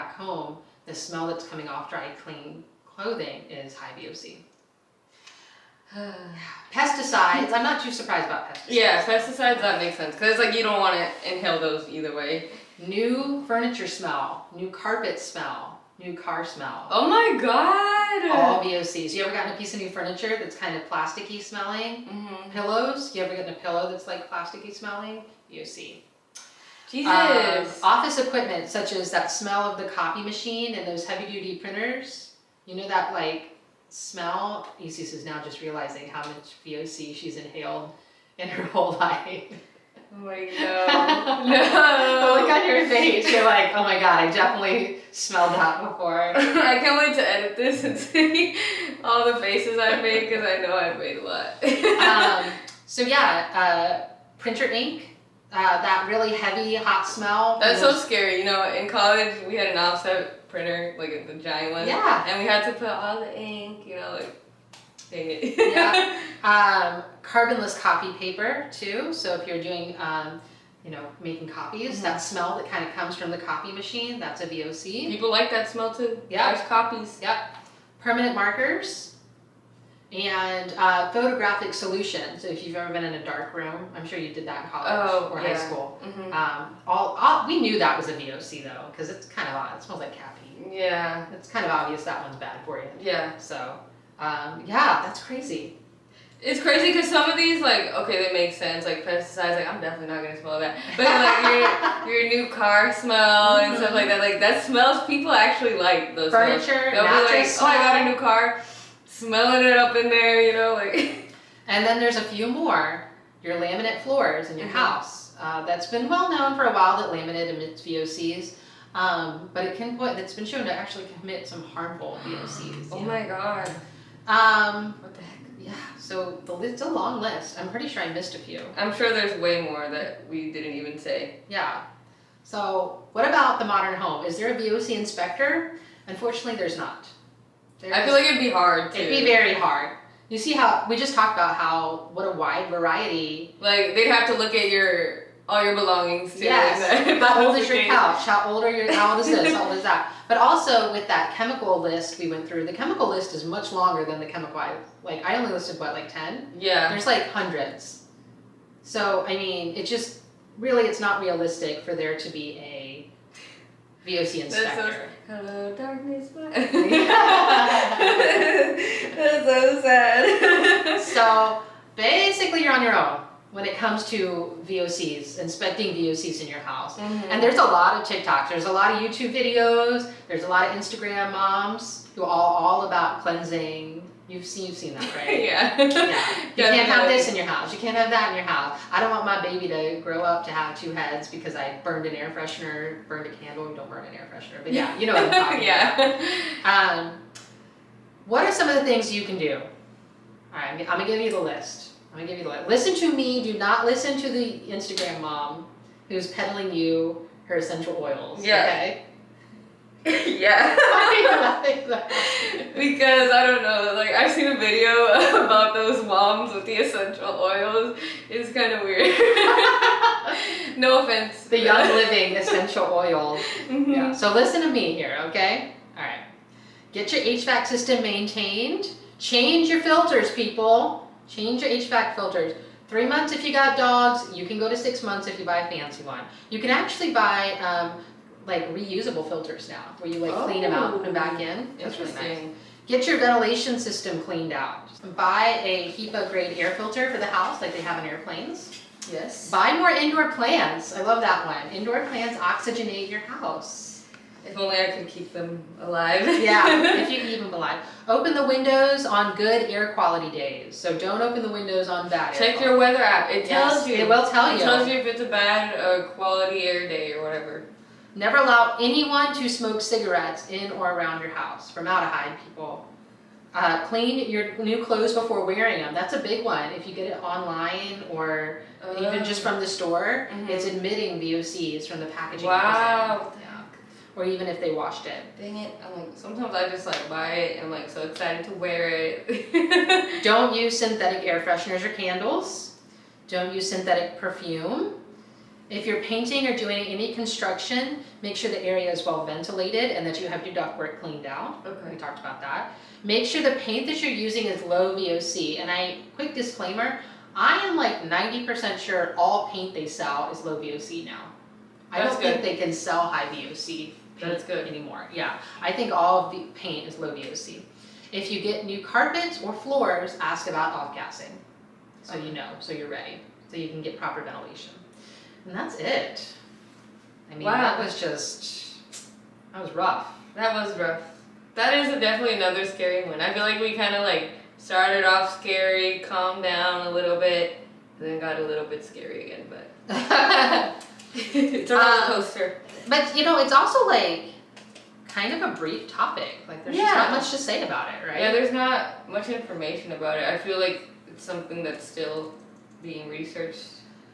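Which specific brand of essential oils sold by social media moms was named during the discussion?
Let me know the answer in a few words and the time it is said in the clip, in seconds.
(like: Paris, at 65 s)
Young Living, at 221 s.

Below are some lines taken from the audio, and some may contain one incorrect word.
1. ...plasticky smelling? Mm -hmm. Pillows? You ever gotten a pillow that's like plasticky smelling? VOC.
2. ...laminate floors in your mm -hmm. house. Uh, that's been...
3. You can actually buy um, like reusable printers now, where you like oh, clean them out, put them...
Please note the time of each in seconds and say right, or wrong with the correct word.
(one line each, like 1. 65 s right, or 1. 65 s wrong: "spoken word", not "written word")
1. 20 s right
2. 113 s right
3. 236 s wrong: "filters", not "printers".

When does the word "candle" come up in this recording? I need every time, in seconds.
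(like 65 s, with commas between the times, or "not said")
193 s, 291 s.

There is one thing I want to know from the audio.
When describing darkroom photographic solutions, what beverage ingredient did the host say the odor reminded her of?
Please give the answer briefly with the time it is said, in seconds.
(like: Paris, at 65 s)
Caffeine, at 90 s.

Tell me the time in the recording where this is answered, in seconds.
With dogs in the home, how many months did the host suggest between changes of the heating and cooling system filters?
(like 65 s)
232 s.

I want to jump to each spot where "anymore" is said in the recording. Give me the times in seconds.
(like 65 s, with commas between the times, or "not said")
314 s.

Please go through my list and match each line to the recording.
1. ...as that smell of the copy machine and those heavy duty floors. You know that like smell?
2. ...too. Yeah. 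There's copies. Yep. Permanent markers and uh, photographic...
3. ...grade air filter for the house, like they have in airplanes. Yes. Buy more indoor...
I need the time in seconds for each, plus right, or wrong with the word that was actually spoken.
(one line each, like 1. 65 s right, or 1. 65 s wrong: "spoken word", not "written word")
1. 29 s wrong: "printers", not "floors"
2. 75 s right
3. 246 s right.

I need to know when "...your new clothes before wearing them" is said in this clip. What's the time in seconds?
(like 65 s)
274 s.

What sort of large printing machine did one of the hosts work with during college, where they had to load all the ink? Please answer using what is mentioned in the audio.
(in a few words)
Offset printer.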